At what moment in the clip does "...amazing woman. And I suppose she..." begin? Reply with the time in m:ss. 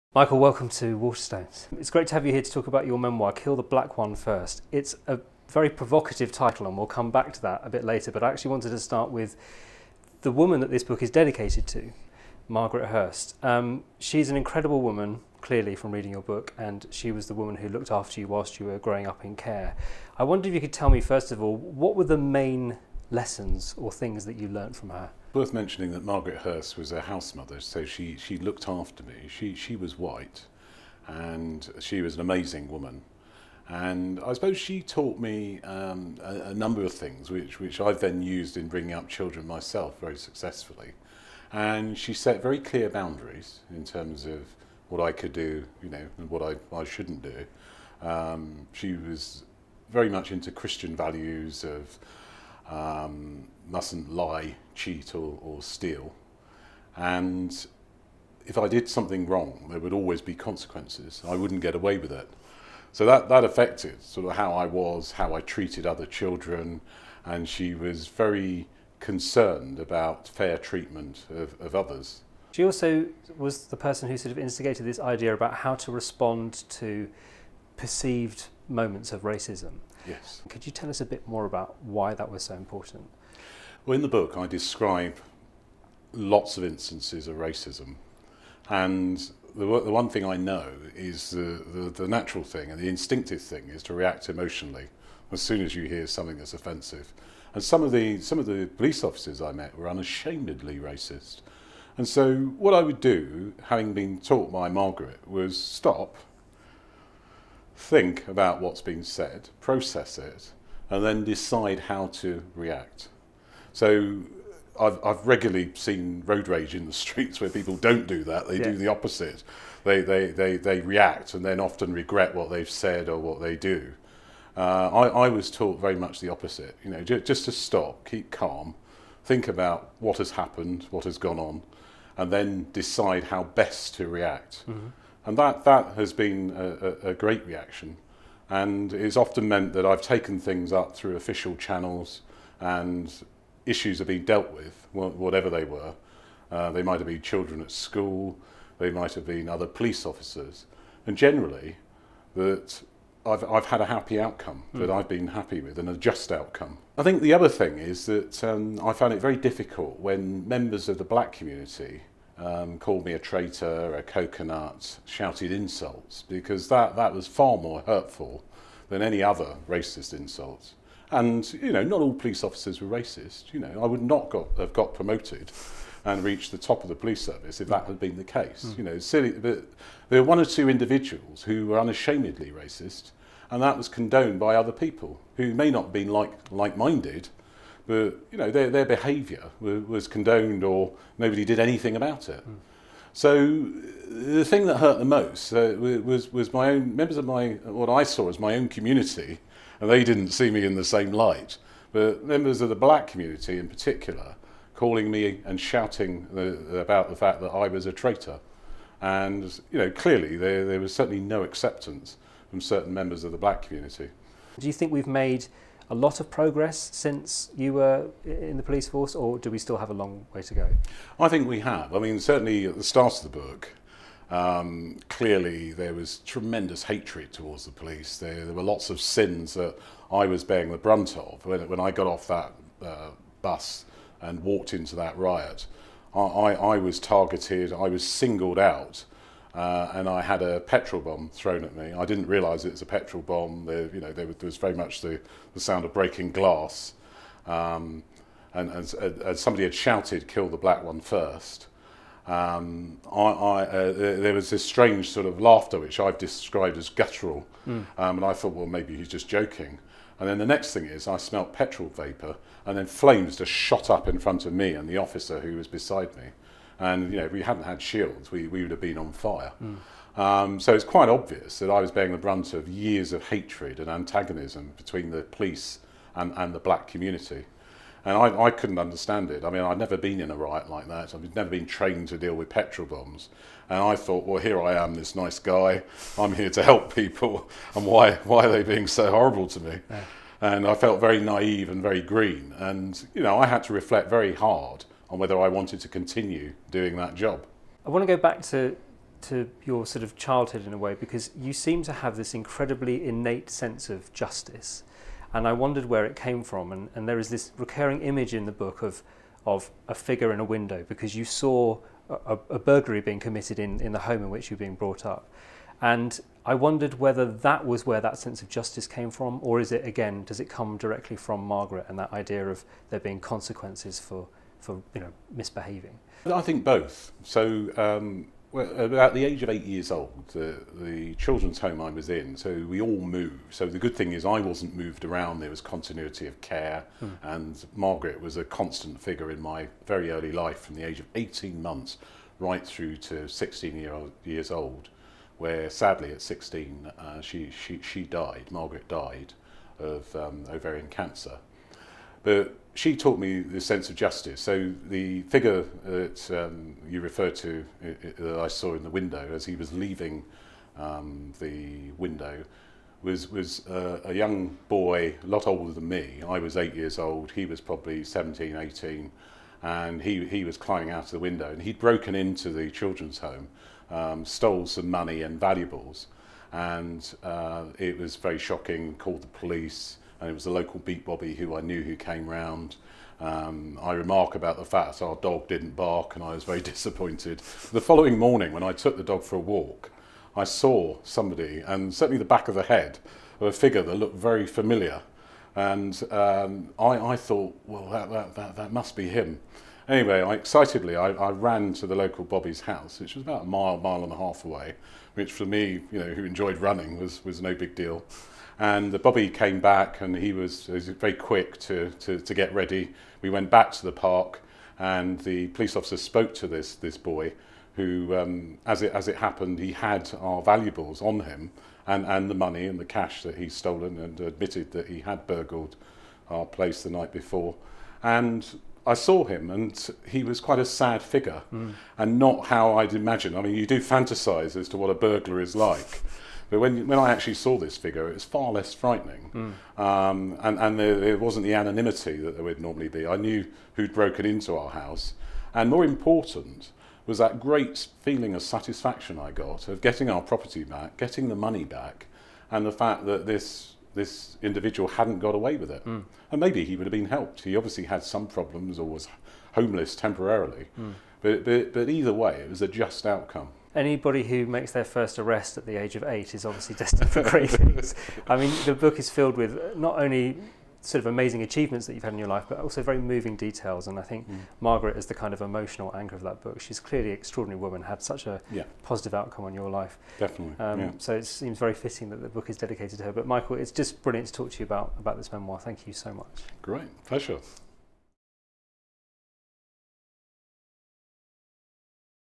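0:32.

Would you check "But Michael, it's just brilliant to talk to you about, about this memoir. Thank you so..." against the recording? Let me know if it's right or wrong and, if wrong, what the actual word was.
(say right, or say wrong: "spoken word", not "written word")
right.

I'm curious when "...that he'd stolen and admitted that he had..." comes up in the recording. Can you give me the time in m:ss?
7:03.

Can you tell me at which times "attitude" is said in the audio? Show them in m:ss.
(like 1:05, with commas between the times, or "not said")
not said.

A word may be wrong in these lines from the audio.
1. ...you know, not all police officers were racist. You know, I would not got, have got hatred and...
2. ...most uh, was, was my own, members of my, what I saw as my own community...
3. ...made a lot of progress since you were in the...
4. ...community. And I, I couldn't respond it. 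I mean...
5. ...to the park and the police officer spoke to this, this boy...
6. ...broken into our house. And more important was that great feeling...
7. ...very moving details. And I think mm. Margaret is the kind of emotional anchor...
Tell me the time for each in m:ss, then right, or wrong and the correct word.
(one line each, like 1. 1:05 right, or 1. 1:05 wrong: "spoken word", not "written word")
1. 2:51 wrong: "promoted", not "hatred"
2. 3:15 right
3. 3:35 right
4. 4:36 wrong: "understand", not "respond"
5. 6:53 right
6. 7:23 right
7. 7:52 right.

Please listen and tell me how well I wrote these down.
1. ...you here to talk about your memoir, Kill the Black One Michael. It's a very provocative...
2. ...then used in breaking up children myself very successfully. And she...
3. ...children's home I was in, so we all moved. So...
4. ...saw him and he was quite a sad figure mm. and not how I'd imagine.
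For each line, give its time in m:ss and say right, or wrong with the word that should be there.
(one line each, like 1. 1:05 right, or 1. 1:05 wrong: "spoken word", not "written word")
1. 0:02 wrong: "First", not "Michael"
2. 0:38 wrong: "bringing", not "breaking"
3. 5:31 right
4. 7:08 right.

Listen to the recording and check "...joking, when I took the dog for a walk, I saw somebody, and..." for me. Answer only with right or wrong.
wrong.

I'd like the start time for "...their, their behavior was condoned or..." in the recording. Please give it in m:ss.
3:08.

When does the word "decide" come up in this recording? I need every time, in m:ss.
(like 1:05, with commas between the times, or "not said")
1:51, 2:12.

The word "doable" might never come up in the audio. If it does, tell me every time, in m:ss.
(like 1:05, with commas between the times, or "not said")
not said.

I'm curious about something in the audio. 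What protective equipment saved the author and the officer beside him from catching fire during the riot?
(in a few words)
Shields.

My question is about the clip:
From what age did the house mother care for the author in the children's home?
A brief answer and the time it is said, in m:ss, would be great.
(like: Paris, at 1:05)
18 months, at 5:41.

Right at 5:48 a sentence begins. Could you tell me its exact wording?
Margaret died of um, ovarian cancer, but she taught me the sense of justice.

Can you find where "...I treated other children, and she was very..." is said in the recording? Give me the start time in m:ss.
1:05.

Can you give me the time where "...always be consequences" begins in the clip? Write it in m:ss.
0:59.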